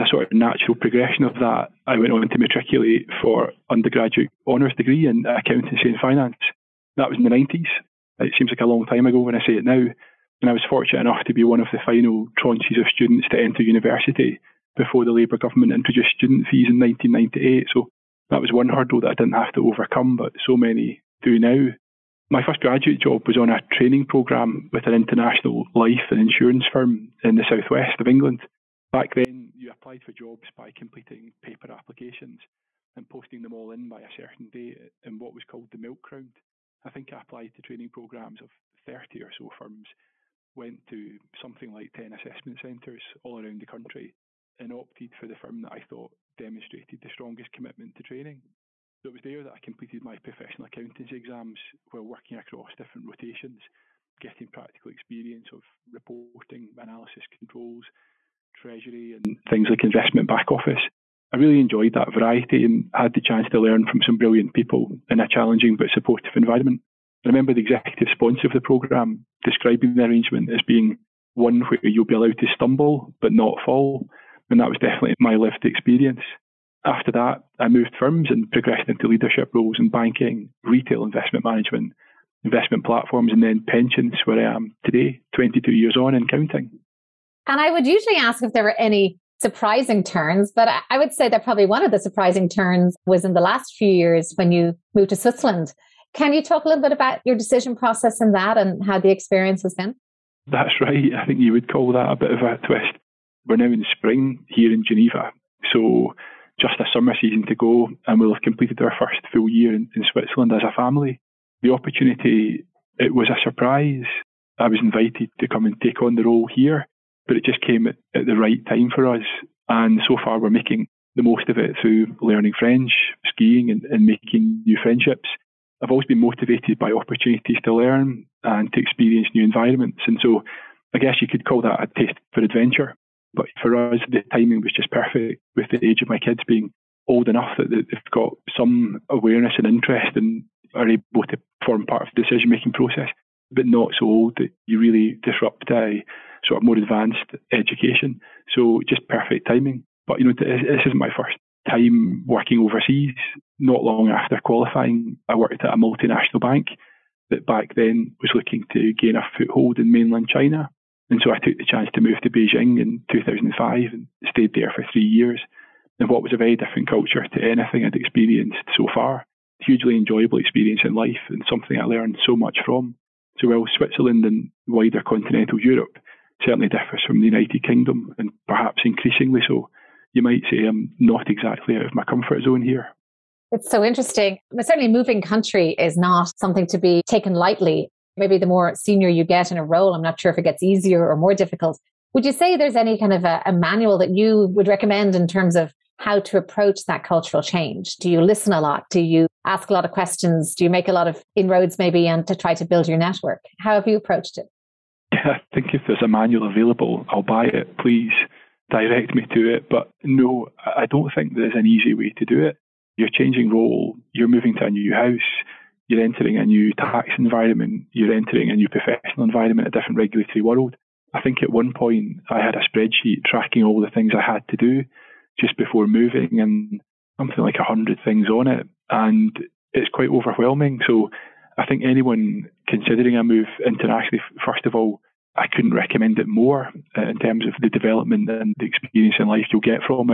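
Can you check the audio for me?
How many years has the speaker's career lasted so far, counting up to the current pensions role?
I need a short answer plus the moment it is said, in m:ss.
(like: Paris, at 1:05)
22, at 1:25.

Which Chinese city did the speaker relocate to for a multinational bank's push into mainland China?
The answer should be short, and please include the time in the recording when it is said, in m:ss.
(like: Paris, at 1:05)
Beijing, at 2:42.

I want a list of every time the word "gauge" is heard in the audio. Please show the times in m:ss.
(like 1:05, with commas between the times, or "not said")
not said.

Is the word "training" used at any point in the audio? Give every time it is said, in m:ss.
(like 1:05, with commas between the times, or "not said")
0:23, 0:37, 0:48.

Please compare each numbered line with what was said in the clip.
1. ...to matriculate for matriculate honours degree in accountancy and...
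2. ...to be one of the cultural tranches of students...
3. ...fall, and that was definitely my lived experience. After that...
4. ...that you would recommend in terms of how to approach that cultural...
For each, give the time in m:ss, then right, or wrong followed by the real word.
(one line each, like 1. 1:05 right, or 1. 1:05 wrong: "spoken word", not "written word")
1. 0:02 wrong: "undergraduate", not "matriculate"
2. 0:11 wrong: "final", not "cultural"
3. 1:13 right
4. 3:13 right.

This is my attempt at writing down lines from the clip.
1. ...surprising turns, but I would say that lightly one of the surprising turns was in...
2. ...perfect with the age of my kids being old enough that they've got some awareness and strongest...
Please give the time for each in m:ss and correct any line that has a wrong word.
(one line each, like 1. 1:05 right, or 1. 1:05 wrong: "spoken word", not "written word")
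1. 1:29 wrong: "probably", not "lightly"
2. 2:14 wrong: "interest", not "strongest".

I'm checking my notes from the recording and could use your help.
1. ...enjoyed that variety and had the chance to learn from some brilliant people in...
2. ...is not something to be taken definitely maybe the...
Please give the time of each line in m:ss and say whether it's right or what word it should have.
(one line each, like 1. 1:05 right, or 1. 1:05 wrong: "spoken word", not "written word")
1. 1:01 right
2. 3:05 wrong: "lightly", not "definitely".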